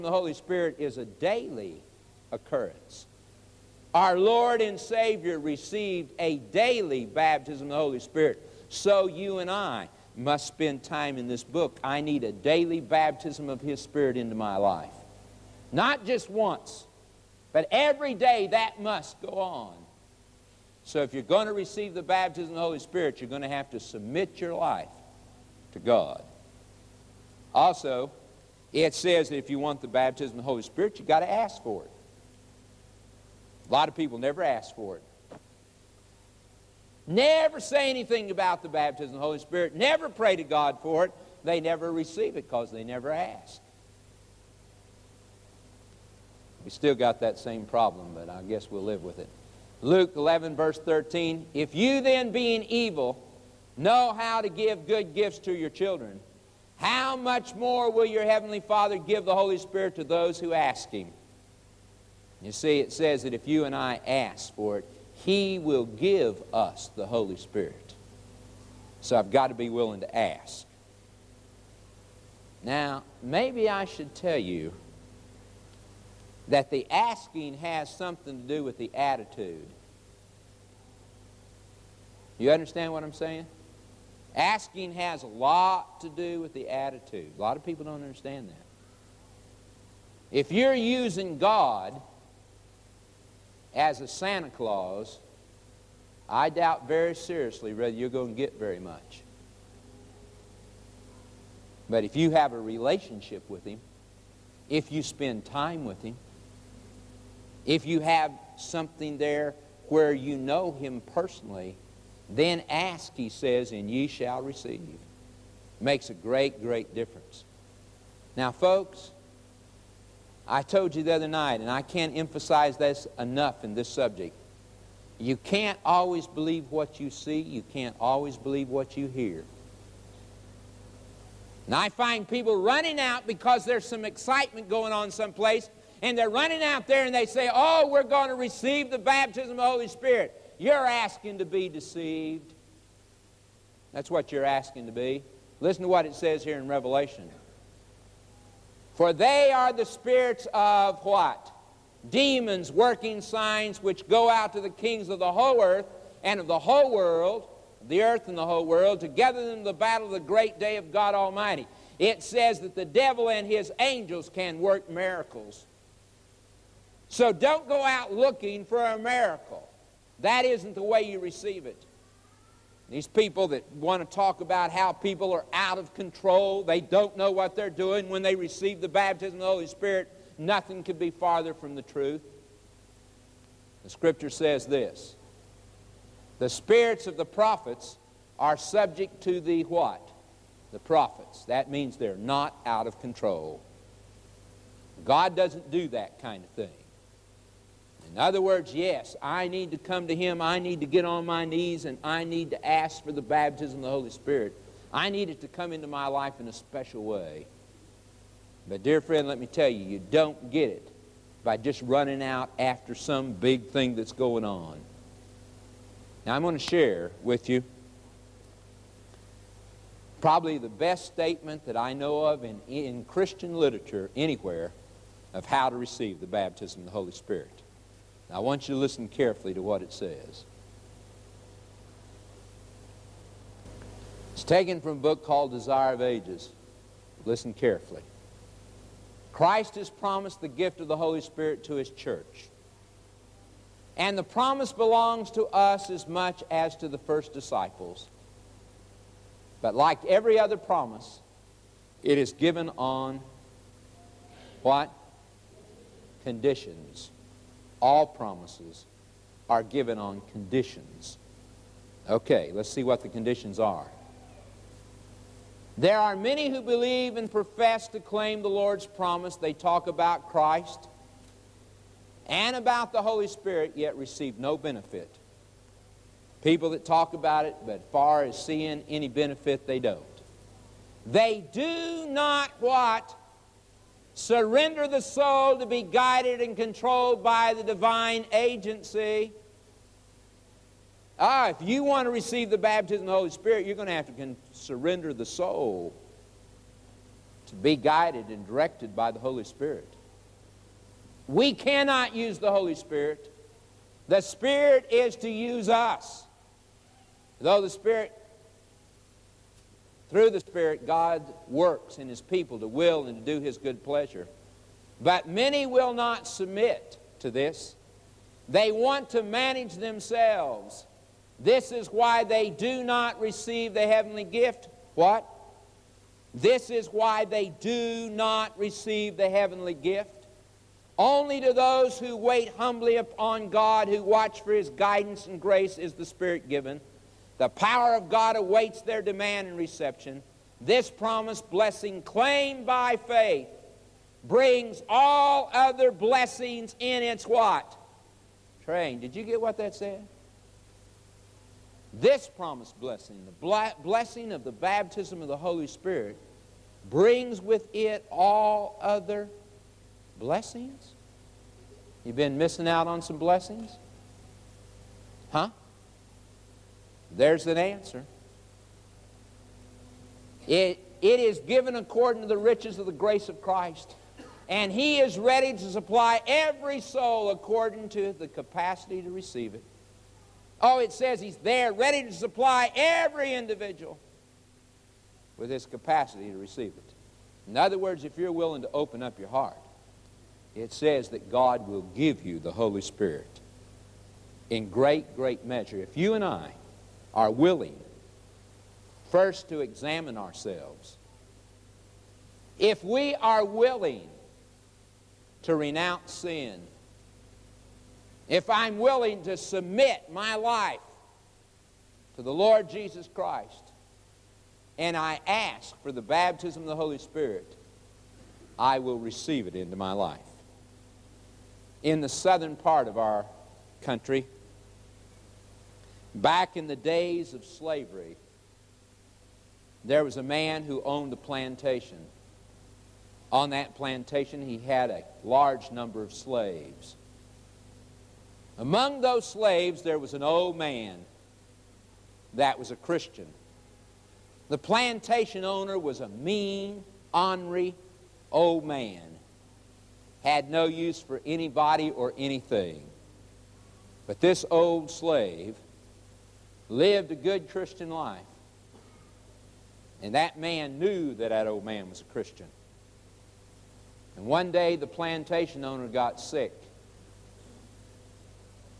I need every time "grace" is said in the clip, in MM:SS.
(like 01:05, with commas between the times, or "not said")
05:35, 06:12.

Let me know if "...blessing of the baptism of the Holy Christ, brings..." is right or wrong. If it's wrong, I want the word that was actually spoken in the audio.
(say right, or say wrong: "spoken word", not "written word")
wrong: "Spirit", not "Christ".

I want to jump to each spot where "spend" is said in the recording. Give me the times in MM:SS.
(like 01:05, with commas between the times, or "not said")
00:10, 01:45.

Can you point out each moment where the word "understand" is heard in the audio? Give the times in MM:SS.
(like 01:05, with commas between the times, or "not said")
01:22, 01:28.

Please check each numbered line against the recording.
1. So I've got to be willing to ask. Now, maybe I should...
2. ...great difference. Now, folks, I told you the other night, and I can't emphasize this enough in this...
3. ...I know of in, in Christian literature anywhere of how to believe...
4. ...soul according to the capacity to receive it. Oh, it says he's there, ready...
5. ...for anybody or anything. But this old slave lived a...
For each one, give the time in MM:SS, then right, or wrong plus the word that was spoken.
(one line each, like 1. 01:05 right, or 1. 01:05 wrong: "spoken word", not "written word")
1. 01:09 right
2. 01:56 right
3. 03:41 wrong: "receive", not "believe"
4. 06:16 right
5. 07:30 right.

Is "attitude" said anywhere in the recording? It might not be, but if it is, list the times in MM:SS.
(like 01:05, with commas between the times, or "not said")
01:18, 01:26.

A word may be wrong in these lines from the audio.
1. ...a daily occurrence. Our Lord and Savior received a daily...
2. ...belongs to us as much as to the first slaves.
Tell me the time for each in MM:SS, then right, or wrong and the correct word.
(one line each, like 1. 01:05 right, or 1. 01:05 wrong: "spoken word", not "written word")
1. 00:00 right
2. 04:04 wrong: "disciples", not "slaves".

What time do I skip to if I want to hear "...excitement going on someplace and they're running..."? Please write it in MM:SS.
02:14.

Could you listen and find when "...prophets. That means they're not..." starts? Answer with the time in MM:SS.
03:10.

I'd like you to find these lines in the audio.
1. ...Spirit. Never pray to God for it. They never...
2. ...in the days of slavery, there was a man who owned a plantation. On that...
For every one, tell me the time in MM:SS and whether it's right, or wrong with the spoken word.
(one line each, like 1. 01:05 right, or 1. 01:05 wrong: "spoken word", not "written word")
1. 00:39 right
2. 07:06 right.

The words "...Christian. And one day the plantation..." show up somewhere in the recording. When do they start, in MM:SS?
07:42.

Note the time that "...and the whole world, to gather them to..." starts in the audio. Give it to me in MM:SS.
02:38.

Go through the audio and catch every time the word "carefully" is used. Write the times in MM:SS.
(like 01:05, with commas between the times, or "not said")
03:49, 03:57.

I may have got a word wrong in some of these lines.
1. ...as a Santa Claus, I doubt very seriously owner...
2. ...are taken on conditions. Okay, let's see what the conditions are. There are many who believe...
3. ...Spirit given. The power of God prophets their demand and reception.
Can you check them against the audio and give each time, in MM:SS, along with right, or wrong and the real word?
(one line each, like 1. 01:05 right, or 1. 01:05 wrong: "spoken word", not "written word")
1. 01:33 wrong: "whether", not "owner"
2. 04:19 wrong: "given", not "taken"
3. 05:36 wrong: "awaits", not "prophets".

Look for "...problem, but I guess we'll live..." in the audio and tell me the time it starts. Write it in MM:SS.
00:47.